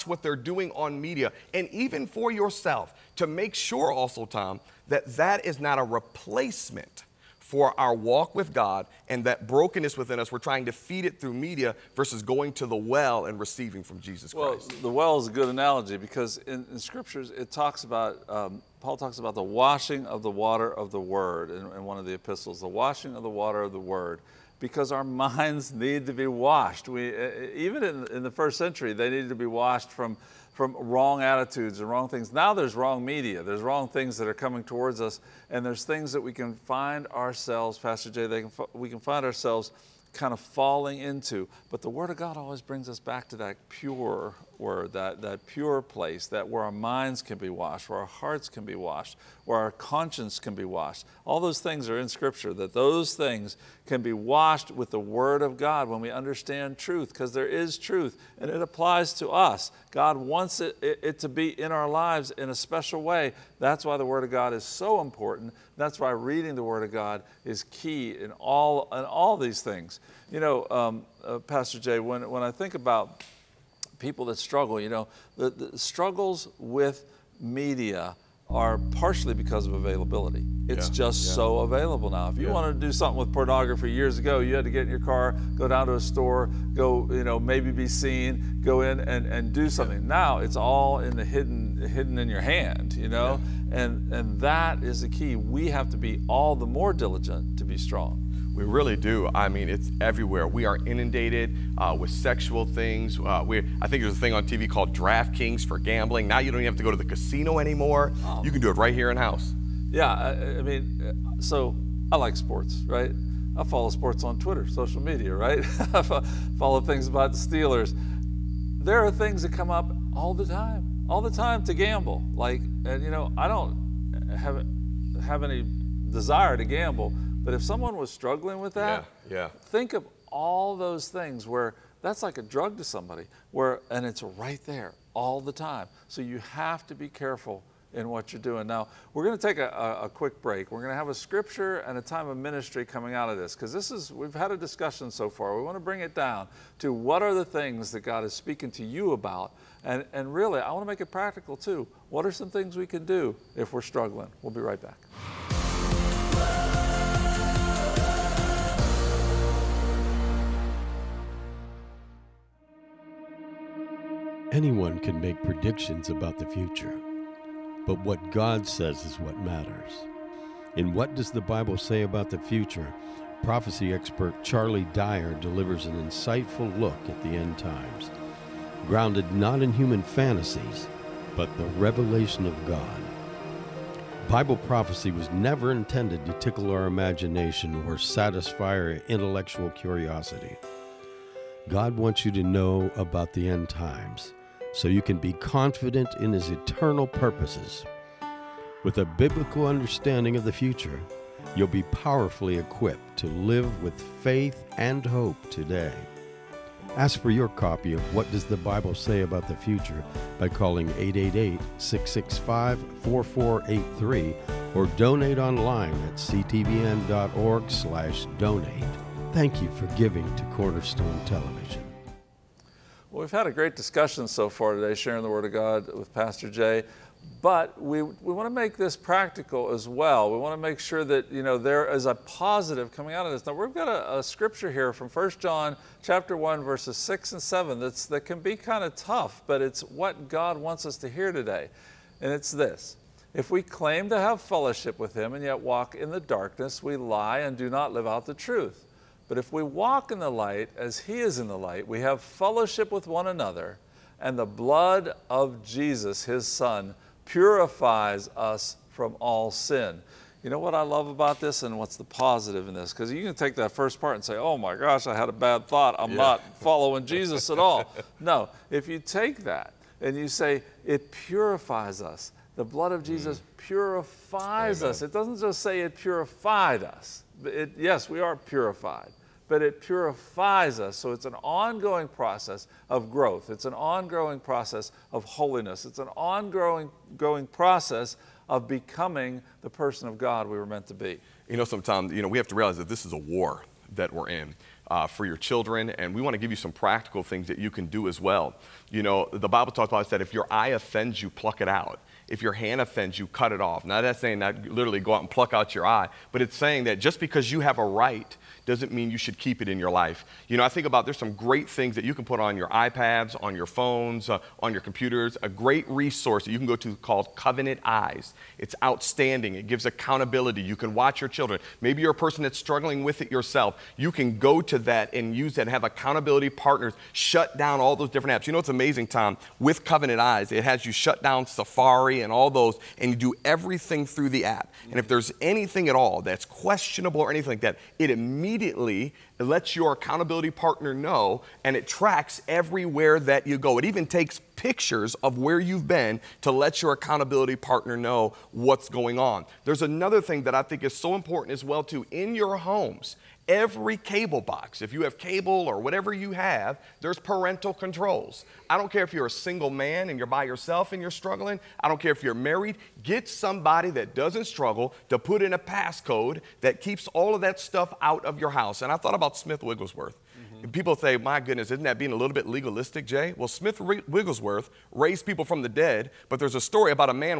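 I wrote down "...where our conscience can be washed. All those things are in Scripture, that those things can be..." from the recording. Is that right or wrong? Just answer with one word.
right.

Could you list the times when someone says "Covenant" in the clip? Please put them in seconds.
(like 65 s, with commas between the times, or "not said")
317 s, 329 s.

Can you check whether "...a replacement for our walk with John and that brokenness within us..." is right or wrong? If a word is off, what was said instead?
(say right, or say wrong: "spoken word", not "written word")
wrong: "God", not "John".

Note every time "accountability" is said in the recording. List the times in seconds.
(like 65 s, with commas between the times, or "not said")
319 s, 325 s, 339 s, 346 s.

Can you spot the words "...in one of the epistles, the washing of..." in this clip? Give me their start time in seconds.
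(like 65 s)
21 s.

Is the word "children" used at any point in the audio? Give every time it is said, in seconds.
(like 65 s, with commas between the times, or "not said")
295 s, 321 s.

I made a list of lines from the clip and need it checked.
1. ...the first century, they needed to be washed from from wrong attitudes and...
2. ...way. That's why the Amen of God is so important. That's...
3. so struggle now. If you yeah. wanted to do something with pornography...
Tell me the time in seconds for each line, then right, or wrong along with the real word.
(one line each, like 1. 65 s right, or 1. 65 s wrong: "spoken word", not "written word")
1. 28 s right
2. 63 s wrong: "Word", not "Amen"
3. 81 s wrong: "available", not "struggle".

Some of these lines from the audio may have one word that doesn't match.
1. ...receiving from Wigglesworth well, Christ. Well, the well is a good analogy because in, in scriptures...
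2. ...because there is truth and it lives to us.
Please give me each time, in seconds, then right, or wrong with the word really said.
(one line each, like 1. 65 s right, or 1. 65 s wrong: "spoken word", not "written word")
1. 13 s wrong: "Jesus", not "Wigglesworth"
2. 57 s wrong: "applies", not "lives".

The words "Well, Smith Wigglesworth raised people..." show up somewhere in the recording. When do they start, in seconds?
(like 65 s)
373 s.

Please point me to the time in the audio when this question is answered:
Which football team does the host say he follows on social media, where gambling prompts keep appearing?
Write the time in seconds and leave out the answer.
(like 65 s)
117 s.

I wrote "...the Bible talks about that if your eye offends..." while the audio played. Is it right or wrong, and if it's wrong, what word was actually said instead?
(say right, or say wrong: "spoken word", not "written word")
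right.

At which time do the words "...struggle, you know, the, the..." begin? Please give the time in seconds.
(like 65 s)
74 s.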